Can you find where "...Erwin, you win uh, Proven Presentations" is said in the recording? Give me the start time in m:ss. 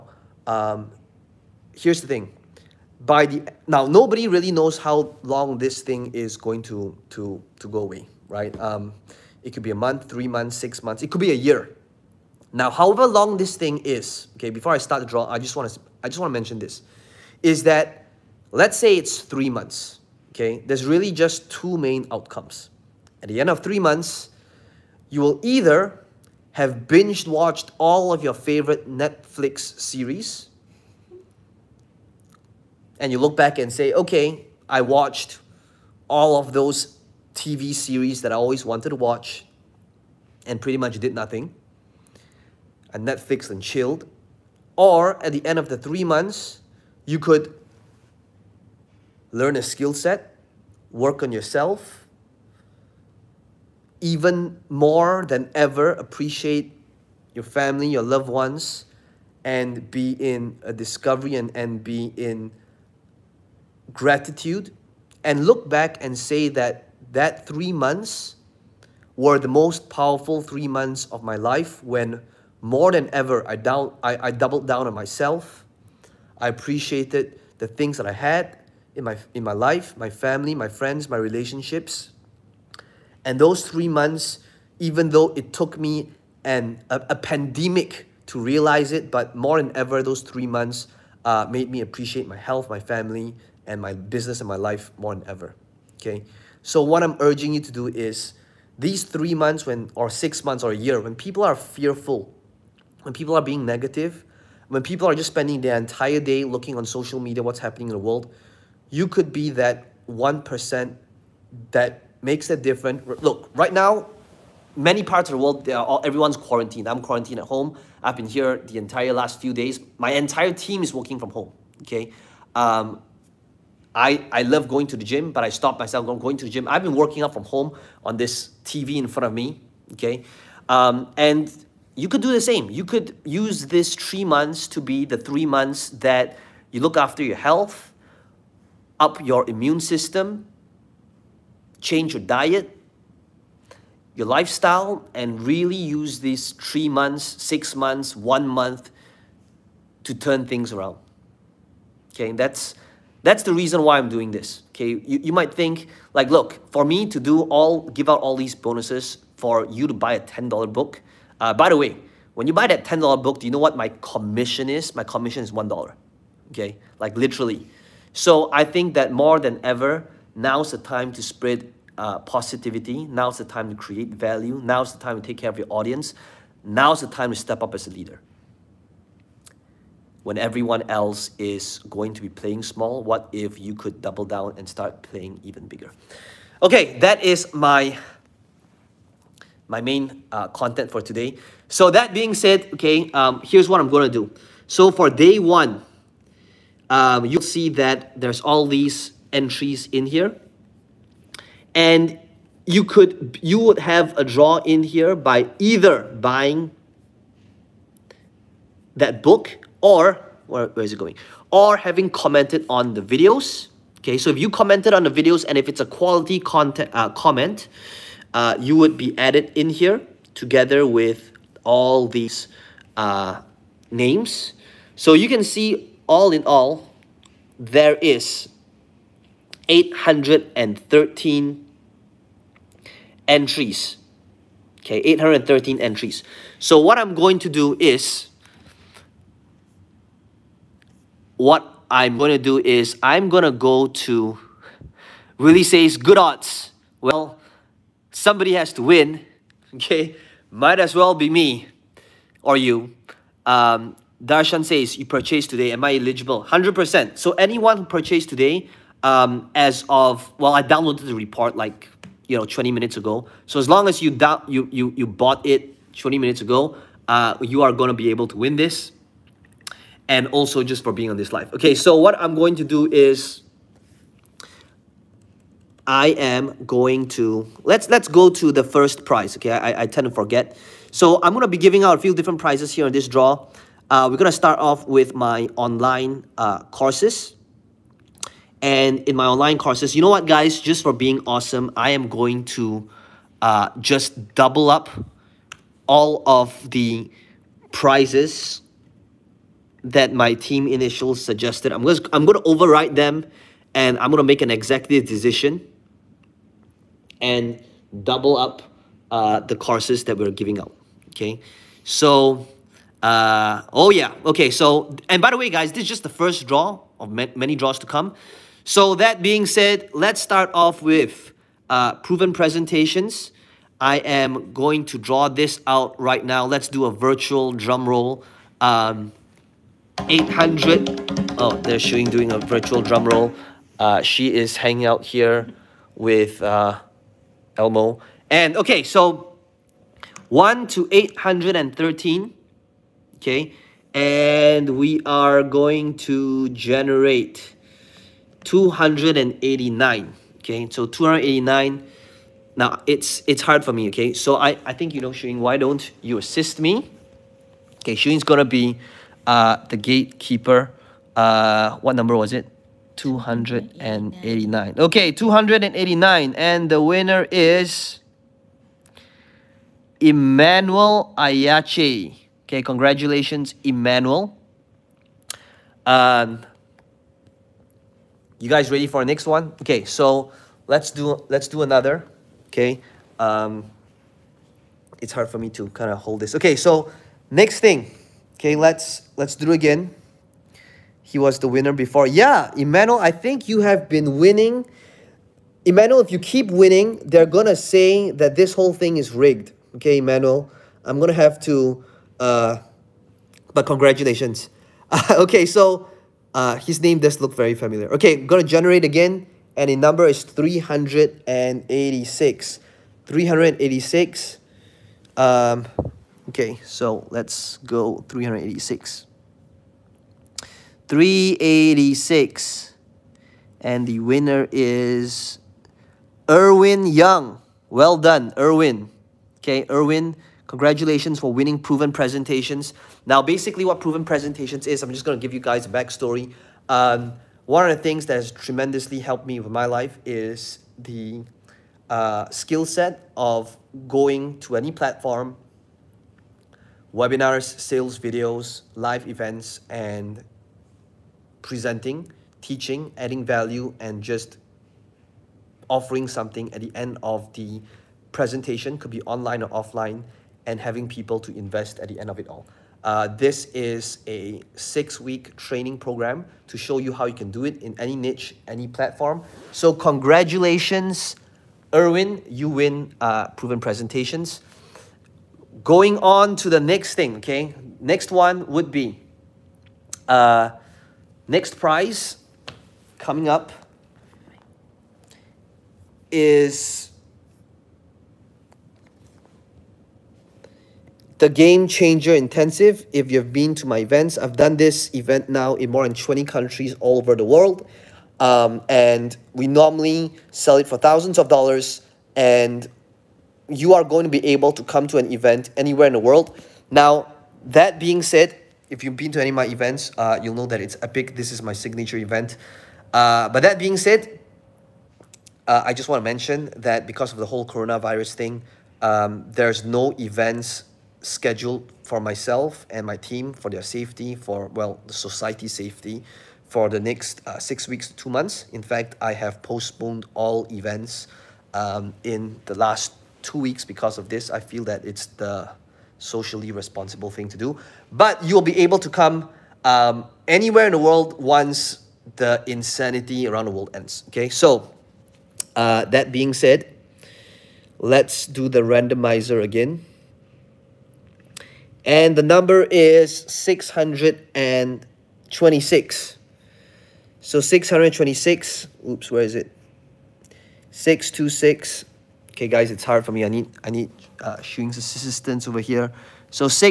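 7:51.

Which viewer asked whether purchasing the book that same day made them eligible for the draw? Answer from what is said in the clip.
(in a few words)
Darshan.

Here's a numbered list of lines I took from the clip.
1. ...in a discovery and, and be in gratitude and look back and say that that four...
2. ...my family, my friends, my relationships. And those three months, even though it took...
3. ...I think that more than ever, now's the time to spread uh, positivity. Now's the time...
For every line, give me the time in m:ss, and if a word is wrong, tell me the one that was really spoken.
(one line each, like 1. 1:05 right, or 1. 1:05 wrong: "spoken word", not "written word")
1. 1:00 wrong: "three", not "four"
2. 1:19 right
3. 2:48 right.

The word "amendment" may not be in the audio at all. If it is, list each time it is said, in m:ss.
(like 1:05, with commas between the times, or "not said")
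not said.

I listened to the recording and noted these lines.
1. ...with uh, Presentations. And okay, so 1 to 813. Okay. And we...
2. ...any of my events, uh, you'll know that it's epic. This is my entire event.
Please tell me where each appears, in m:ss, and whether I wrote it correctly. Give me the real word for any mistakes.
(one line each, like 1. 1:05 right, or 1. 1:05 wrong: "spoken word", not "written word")
1. 5:35 wrong: "Elmo", not "Presentations"
2. 8:29 wrong: "signature", not "entire".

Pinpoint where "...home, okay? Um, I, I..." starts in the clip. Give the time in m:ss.
2:01.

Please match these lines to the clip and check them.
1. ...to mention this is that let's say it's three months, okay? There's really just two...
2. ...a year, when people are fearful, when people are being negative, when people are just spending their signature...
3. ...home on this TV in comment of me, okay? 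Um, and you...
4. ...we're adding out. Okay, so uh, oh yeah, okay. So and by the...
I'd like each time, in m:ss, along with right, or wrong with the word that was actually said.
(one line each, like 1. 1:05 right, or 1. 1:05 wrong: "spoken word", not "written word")
1. 0:16 right
2. 1:40 wrong: "entire", not "signature"
3. 2:07 wrong: "front", not "comment"
4. 5:10 wrong: "giving", not "adding".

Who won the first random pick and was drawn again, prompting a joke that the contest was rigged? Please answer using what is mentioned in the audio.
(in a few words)
Emmanuel Ayache.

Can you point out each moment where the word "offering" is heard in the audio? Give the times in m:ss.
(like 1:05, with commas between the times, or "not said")
7:35.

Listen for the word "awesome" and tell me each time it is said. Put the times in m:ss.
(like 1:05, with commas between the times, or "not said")
4:51.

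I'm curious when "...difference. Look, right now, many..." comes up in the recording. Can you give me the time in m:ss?
1:52.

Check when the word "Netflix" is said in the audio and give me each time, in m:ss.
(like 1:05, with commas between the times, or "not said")
0:28, 0:43.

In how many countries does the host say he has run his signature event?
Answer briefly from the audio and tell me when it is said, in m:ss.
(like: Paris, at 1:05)
more than 20, at 8:15.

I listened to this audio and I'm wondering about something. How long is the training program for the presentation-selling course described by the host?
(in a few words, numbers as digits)
six weeks.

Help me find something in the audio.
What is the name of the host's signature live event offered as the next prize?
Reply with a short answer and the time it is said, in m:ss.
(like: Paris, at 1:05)
Game Changer Intensive, at 8:11.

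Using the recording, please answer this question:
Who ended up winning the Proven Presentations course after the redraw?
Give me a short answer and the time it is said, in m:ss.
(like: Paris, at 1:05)
Erwin Young, at 7:06.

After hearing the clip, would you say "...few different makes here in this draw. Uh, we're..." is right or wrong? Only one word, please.
wrong.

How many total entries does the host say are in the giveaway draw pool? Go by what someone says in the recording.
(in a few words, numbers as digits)
813.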